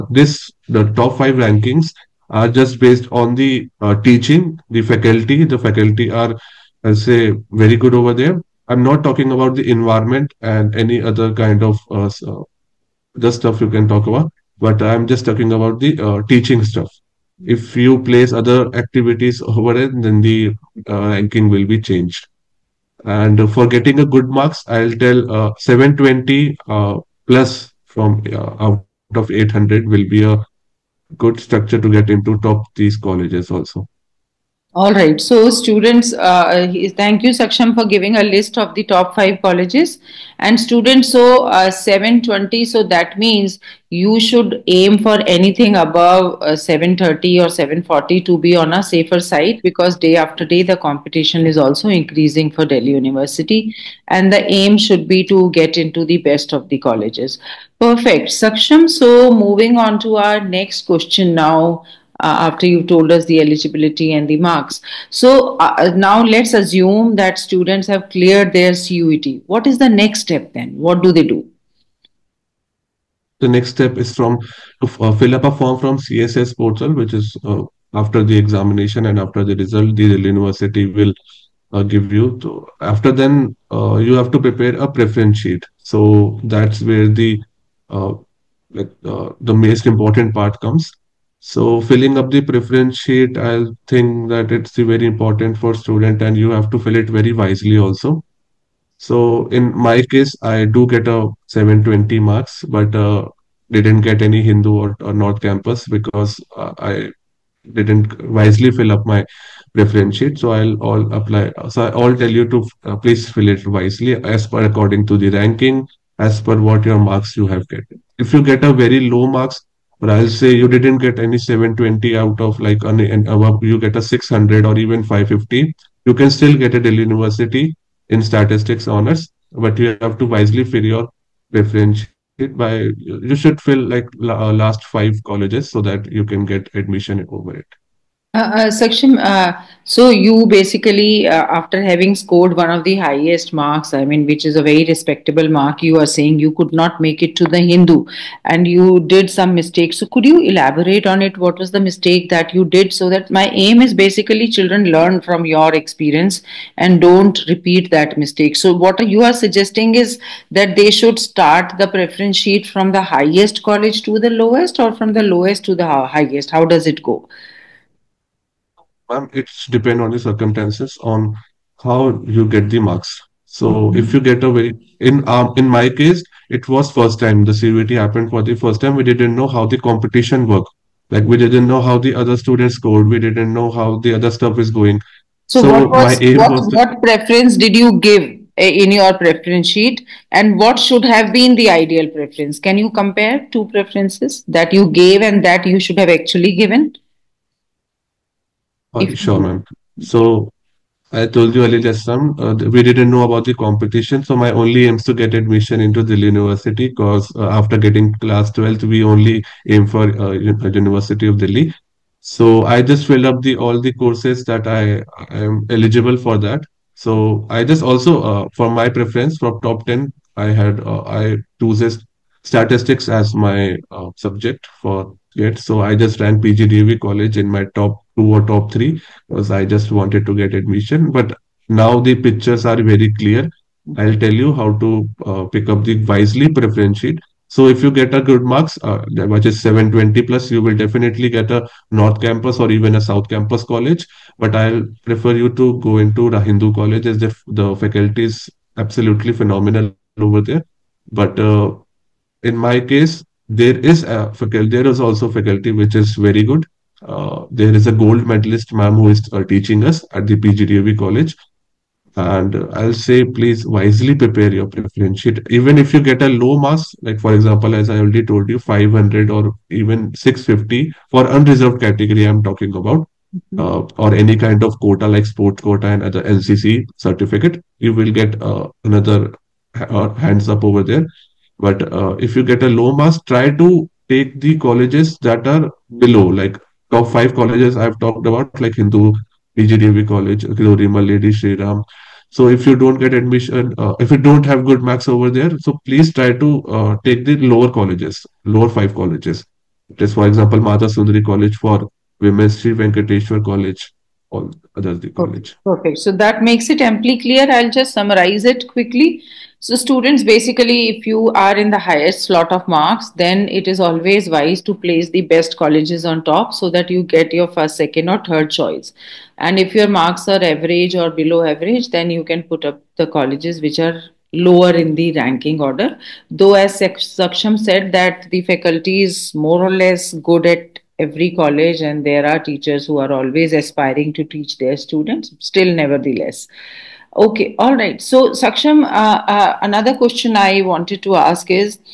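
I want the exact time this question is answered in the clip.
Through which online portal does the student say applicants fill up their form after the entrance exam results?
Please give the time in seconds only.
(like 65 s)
75 s.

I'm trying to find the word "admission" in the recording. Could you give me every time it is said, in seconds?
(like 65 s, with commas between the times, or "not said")
136 s, 205 s, 230 s, 293 s.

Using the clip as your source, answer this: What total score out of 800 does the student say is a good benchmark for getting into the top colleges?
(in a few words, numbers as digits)
720.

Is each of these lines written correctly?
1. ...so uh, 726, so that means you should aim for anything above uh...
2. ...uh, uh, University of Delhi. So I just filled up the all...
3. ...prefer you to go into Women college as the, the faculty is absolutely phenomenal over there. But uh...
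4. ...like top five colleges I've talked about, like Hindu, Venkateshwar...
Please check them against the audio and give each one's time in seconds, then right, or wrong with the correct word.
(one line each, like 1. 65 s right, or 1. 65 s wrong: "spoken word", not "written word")
1. 41 s wrong: "720", not "726"
2. 210 s right
3. 245 s wrong: "Hindu", not "Women"
4. 286 s wrong: "PGDAV", not "Venkateshwar".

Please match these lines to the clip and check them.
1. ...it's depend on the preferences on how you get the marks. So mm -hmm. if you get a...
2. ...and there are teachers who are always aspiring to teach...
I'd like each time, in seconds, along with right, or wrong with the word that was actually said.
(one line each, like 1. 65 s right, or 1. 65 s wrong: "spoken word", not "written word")
1. 169 s wrong: "circumstances", not "preferences"
2. 331 s right.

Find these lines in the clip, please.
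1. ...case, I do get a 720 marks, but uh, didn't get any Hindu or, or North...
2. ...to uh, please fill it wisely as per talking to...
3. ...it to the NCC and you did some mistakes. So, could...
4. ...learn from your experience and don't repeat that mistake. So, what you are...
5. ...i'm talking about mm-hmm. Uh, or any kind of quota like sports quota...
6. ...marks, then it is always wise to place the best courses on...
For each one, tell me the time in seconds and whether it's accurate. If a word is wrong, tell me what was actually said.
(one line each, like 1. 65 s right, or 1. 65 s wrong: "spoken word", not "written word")
1. 100 s right
2. 112 s wrong: "according", not "talking"
3. 147 s wrong: "Hindu", not "NCC"
4. 154 s right
5. 272 s right
6. 312 s wrong: "colleges", not "courses".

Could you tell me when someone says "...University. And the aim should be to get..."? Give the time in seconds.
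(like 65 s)
52 s.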